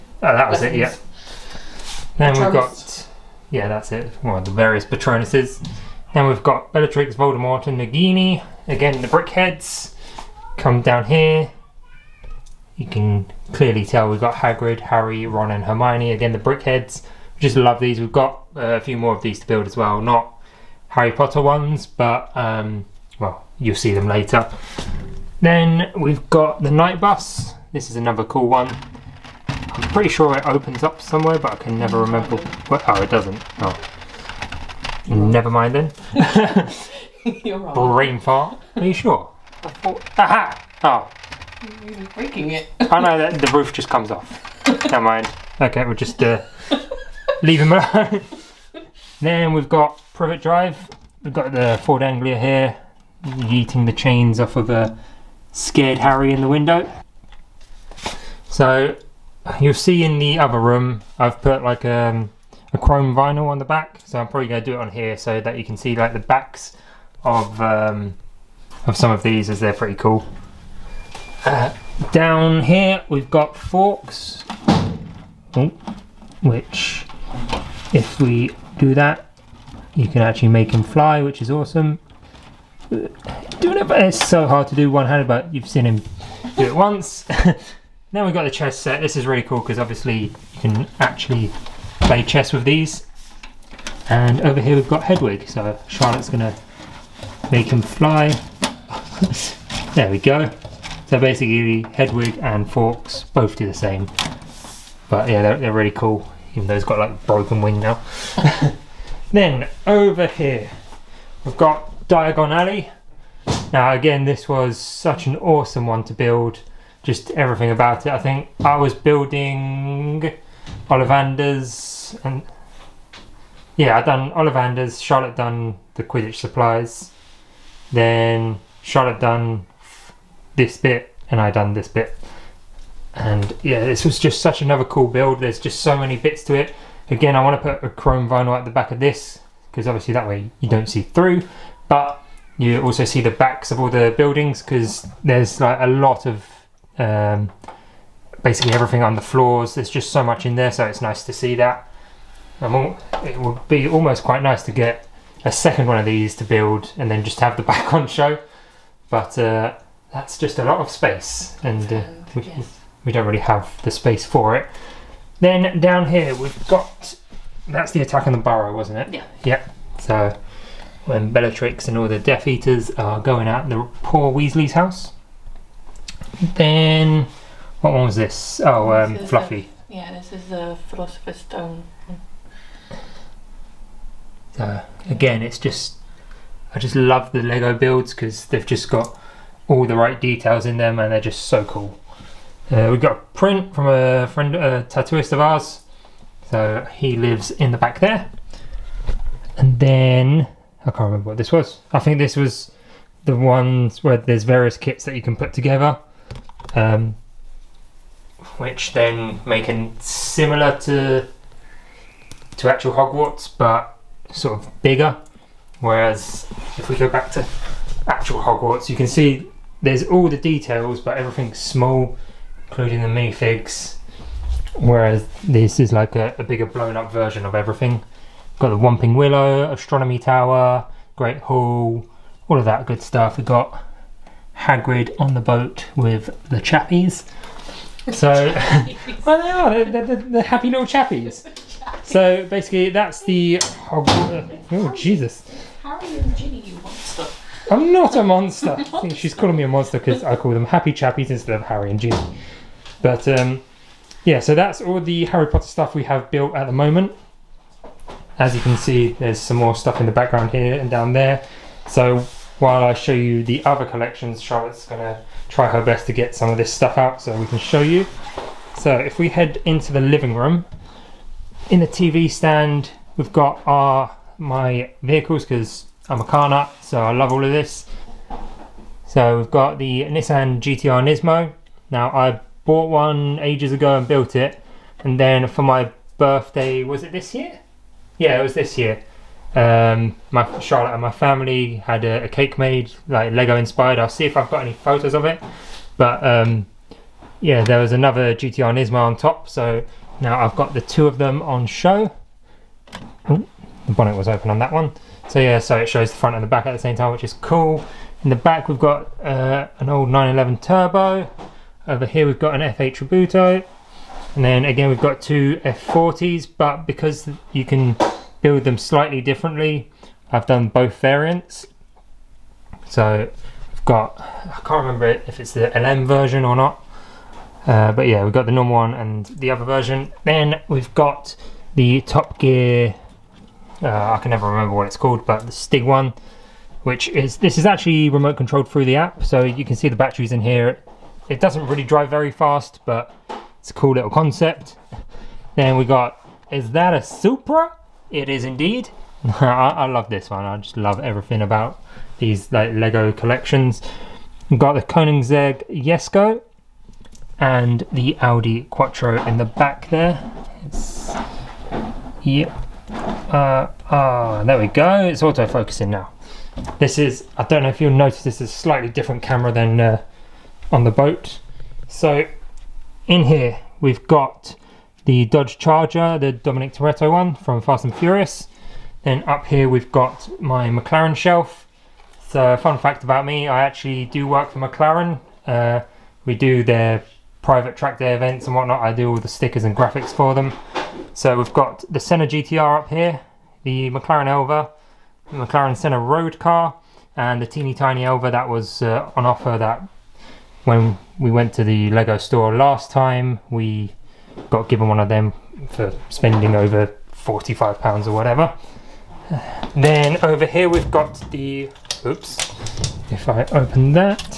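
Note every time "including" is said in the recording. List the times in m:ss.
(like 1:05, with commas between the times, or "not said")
3:42.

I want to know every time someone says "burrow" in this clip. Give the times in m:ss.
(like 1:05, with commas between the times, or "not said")
2:48.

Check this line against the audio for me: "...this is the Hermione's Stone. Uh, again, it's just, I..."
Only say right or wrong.
wrong.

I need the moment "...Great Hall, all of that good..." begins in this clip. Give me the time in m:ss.
3:51.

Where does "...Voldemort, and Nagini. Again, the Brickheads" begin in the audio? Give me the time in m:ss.
0:07.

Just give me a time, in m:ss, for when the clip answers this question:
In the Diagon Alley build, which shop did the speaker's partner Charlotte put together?
2:06.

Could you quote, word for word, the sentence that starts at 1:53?
Now again, this was such an awesome one to build just everything about it.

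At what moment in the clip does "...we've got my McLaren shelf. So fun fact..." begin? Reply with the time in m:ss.
6:19.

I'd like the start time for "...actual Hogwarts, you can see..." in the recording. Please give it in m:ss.
3:38.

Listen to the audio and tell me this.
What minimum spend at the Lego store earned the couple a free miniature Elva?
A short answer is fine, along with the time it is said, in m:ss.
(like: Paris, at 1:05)
45 pounds, at 6:47.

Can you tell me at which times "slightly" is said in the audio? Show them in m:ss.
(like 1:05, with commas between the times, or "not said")
5:18, 6:08.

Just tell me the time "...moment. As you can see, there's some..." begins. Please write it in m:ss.
4:16.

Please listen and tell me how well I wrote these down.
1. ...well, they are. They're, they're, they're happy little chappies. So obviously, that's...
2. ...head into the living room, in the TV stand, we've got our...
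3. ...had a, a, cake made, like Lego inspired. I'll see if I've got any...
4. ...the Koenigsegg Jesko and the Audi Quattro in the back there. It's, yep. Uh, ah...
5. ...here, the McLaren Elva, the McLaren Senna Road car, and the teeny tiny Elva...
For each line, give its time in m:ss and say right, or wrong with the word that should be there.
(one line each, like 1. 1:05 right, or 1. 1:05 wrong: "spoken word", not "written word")
1. 3:59 wrong: "basically", not "obviously"
2. 4:29 right
3. 4:51 right
4. 5:54 right
5. 6:32 right.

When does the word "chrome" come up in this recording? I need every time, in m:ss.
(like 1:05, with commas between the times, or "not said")
1:02, 2:17.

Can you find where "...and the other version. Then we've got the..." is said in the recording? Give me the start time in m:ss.
5:28.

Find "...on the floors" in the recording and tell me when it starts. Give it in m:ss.
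2:29.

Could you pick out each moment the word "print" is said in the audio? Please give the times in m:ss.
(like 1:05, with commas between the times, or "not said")
3:13.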